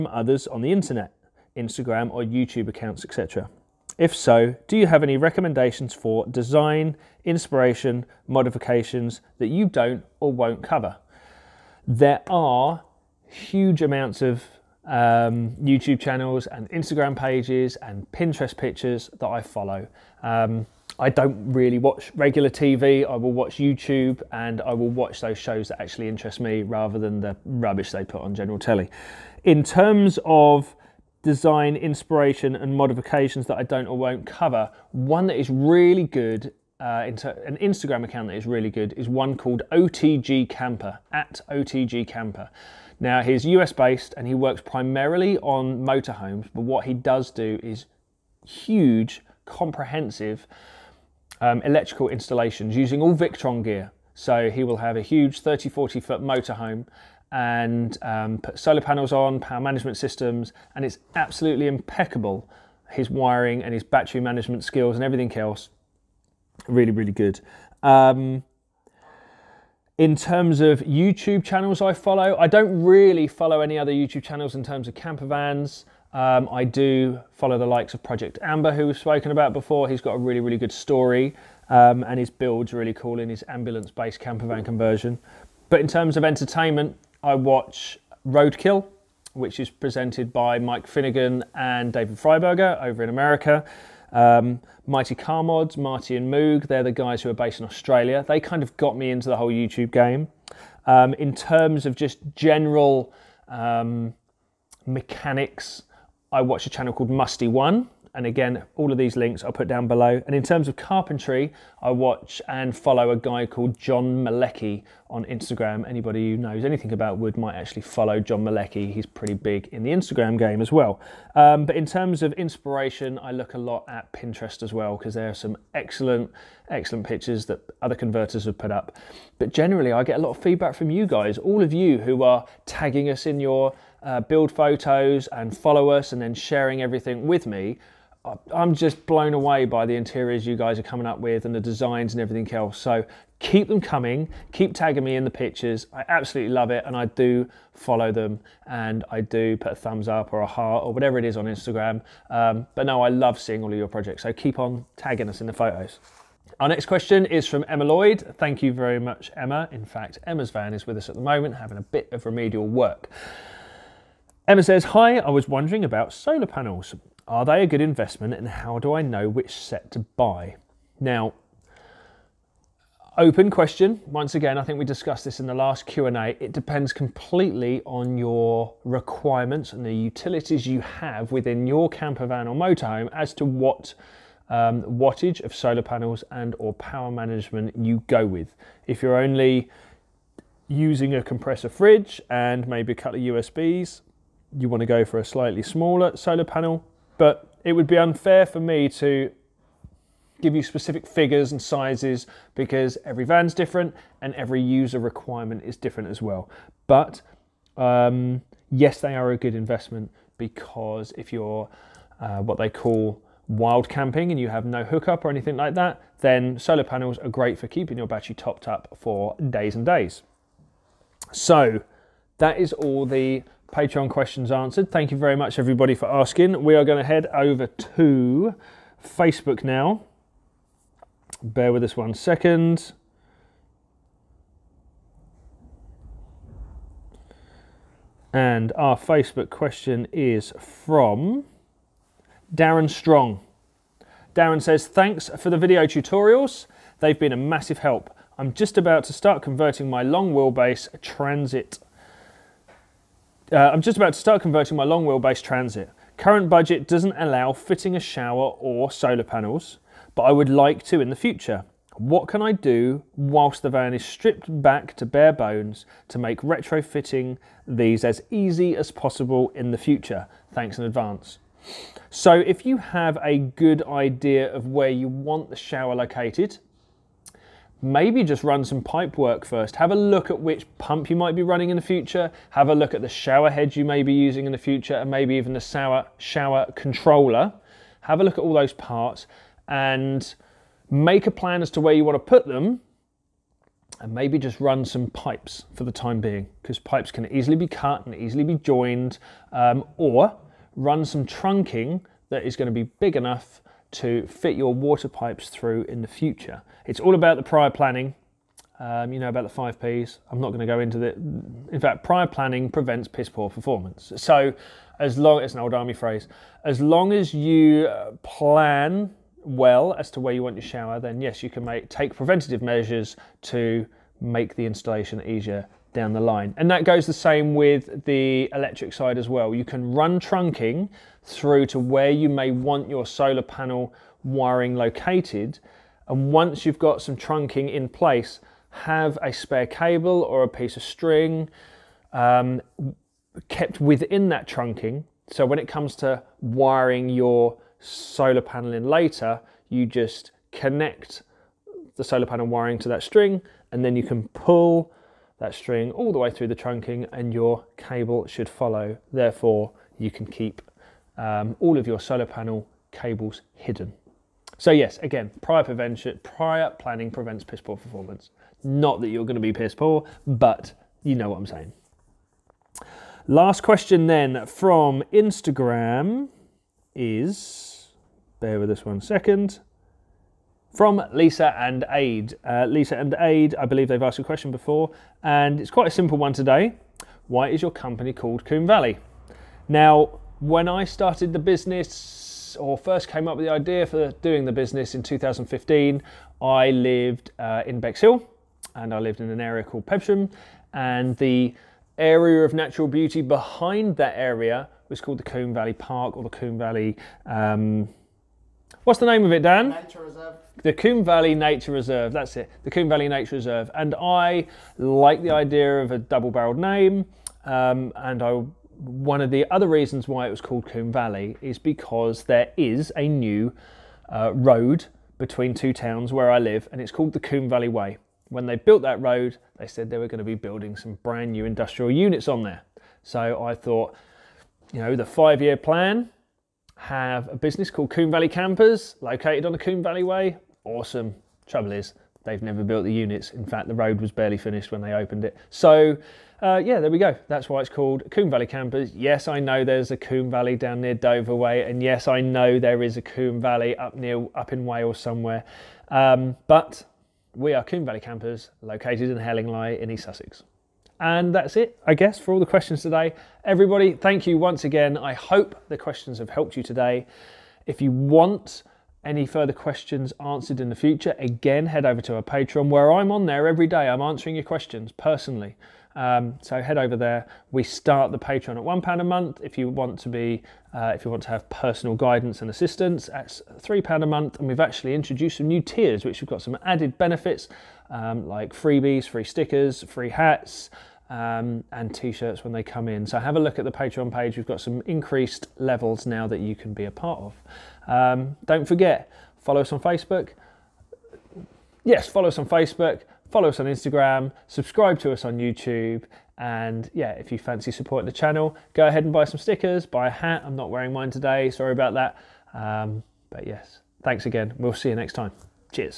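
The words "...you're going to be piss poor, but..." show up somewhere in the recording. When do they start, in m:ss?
6:09.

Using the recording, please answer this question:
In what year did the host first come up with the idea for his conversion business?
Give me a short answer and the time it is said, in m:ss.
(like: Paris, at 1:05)
2015, at 6:35.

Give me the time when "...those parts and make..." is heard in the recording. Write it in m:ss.
4:48.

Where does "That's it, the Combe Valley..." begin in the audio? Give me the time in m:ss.
6:52.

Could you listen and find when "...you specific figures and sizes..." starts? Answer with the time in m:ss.
3:20.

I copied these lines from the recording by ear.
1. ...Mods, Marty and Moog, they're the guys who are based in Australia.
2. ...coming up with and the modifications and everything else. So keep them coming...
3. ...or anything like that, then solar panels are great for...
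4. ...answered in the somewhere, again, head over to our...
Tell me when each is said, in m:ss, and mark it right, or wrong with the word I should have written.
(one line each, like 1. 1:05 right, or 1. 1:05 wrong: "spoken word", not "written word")
1. 1:35 right
2. 2:20 wrong: "designs", not "modifications"
3. 3:35 right
4. 7:50 wrong: "future", not "somewhere".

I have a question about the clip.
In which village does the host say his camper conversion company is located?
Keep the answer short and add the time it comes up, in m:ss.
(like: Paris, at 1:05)
Hellingley, at 7:39.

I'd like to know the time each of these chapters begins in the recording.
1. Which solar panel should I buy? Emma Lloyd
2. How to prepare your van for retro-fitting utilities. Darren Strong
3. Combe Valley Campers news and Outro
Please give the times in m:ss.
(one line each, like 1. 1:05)
1. 2:36
2. 4:02
3. 7:42.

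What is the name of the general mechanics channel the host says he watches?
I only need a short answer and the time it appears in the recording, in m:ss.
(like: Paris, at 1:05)
Mustie1, at 1:47.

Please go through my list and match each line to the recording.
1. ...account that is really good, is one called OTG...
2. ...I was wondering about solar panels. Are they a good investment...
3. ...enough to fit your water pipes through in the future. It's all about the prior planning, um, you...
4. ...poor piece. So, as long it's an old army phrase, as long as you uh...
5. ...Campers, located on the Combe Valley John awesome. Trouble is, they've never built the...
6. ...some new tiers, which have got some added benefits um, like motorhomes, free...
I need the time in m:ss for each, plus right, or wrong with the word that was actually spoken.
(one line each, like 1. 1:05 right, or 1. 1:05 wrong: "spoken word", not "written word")
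1. 0:38 right
2. 2:45 right
3. 5:03 right
4. 5:13 wrong: "performance", not "piece"
5. 7:18 wrong: "Way", not "John"
6. 8:05 wrong: "freebies", not "motorhomes".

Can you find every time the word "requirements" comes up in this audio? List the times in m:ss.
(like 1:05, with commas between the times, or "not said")
2:58, 3:24.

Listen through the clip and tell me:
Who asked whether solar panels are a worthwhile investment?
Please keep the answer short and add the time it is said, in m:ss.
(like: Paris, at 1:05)
Emma Lloyd, at 2:37.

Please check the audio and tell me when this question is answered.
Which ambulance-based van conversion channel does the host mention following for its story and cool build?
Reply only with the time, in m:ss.
1:18.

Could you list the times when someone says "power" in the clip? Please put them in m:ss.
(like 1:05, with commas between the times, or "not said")
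0:59, 3:06.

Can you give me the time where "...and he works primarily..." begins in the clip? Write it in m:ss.
0:44.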